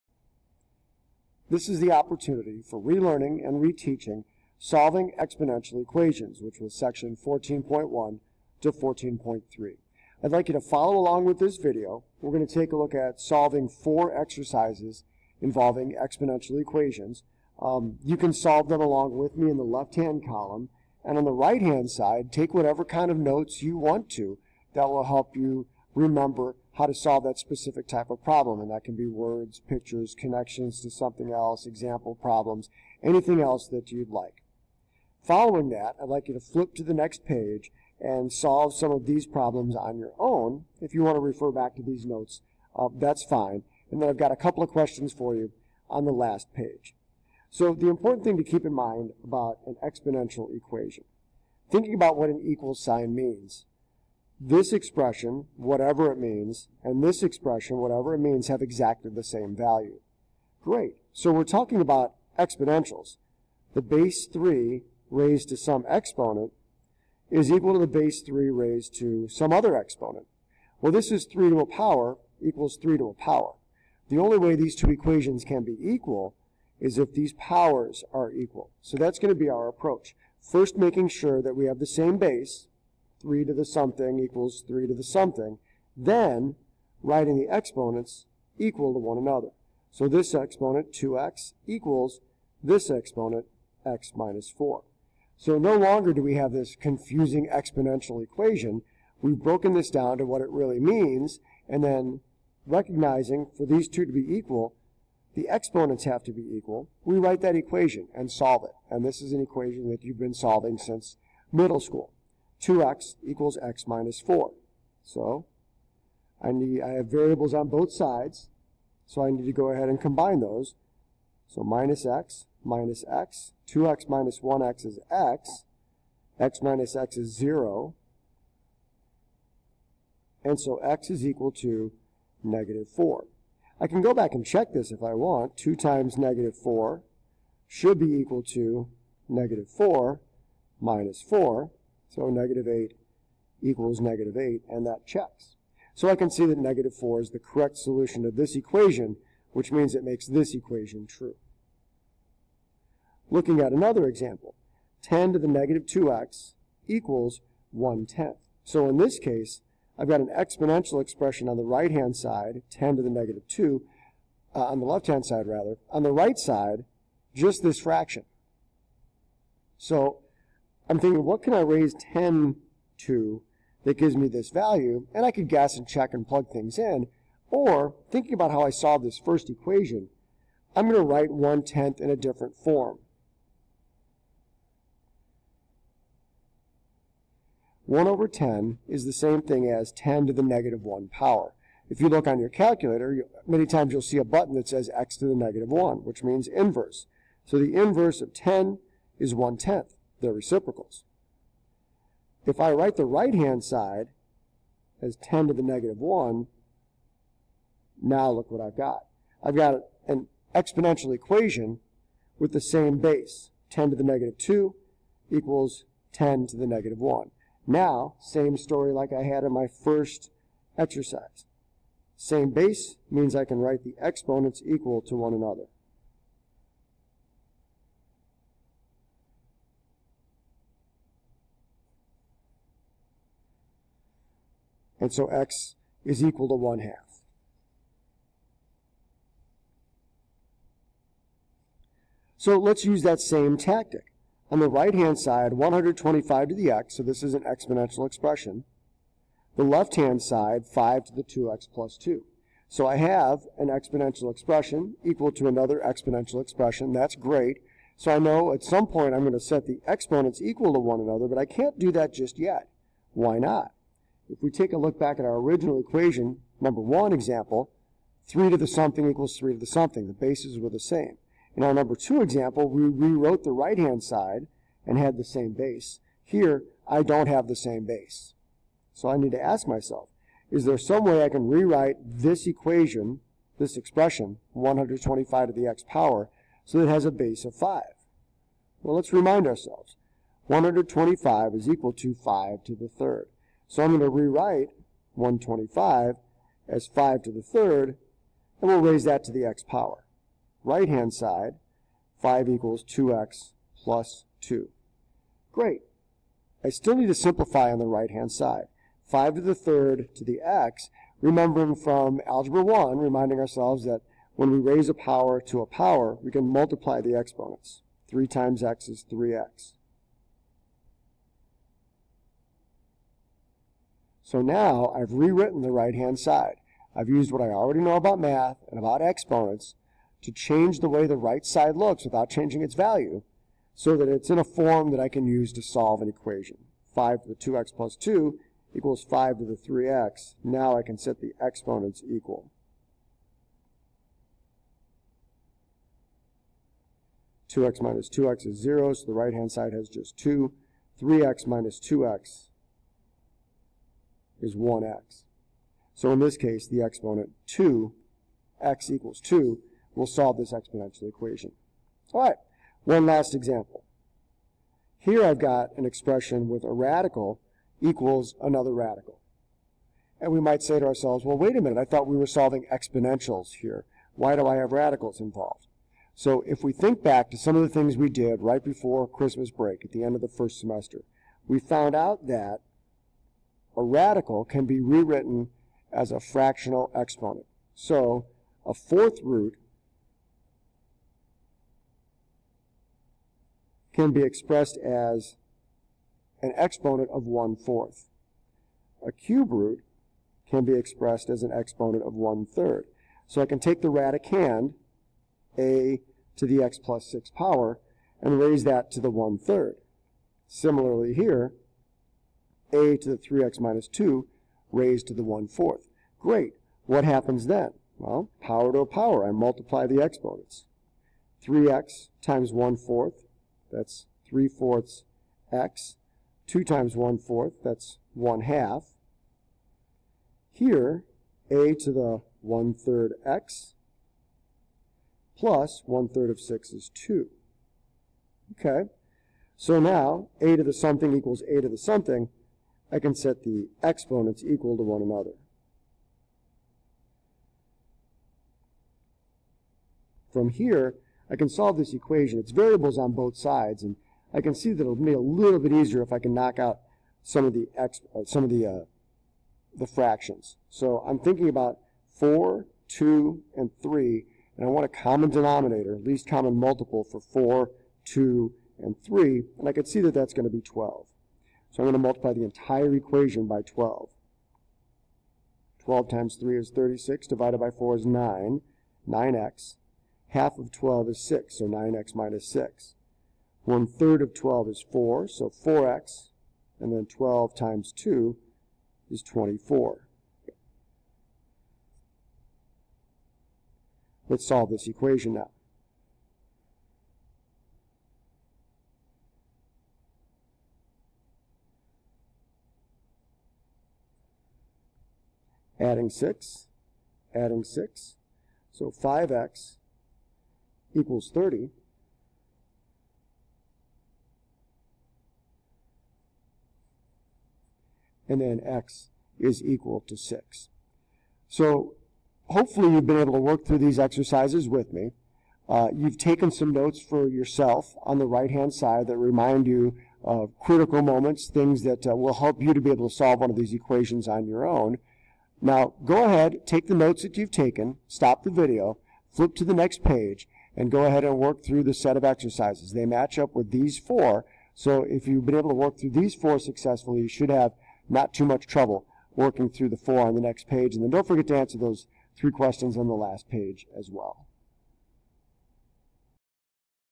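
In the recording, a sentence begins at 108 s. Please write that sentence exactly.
And this is an equation that you've been solving since middle school.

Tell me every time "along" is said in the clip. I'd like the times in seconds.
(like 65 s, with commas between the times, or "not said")
10 s, 18 s.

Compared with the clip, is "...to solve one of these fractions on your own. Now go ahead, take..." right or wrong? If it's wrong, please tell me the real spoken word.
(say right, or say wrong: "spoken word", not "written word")
wrong: "equations", not "fractions".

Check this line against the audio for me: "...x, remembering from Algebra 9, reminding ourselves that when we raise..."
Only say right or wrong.
wrong.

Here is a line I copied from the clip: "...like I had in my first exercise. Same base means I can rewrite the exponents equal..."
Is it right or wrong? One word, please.
wrong.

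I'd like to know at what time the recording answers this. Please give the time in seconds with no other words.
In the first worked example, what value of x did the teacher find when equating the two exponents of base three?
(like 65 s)
130 s.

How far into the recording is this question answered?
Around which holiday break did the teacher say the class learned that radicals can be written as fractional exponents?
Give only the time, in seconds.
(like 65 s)
379 s.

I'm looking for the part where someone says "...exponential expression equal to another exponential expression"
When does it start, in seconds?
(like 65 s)
253 s.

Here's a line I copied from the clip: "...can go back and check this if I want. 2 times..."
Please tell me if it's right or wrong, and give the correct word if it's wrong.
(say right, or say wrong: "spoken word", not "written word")
right.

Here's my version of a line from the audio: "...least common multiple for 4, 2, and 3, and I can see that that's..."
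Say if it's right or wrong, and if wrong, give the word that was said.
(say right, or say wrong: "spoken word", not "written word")
right.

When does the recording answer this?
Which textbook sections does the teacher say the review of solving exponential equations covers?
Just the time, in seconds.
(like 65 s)
7 s.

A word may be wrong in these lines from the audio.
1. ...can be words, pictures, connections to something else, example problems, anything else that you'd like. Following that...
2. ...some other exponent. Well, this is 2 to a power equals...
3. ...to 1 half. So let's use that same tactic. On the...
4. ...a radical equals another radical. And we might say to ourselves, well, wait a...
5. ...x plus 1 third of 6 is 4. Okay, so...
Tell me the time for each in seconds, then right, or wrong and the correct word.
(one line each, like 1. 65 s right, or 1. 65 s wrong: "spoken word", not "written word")
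1. 28 s right
2. 69 s wrong: "3", not "2"
3. 236 s right
4. 366 s right
5. 433 s wrong: "2", not "4".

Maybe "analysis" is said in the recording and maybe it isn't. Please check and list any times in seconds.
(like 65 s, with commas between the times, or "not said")
not said.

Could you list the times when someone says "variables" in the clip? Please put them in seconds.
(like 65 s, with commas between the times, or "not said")
117 s, 452 s.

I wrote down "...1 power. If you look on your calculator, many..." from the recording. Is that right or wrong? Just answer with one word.
right.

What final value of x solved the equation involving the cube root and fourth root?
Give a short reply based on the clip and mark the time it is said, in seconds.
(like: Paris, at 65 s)
6, at 518 s.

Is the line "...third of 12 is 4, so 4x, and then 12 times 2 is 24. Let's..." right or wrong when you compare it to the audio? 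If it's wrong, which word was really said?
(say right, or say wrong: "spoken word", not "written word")
right.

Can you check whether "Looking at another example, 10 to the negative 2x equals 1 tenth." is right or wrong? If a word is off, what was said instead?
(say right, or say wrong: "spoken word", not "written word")
right.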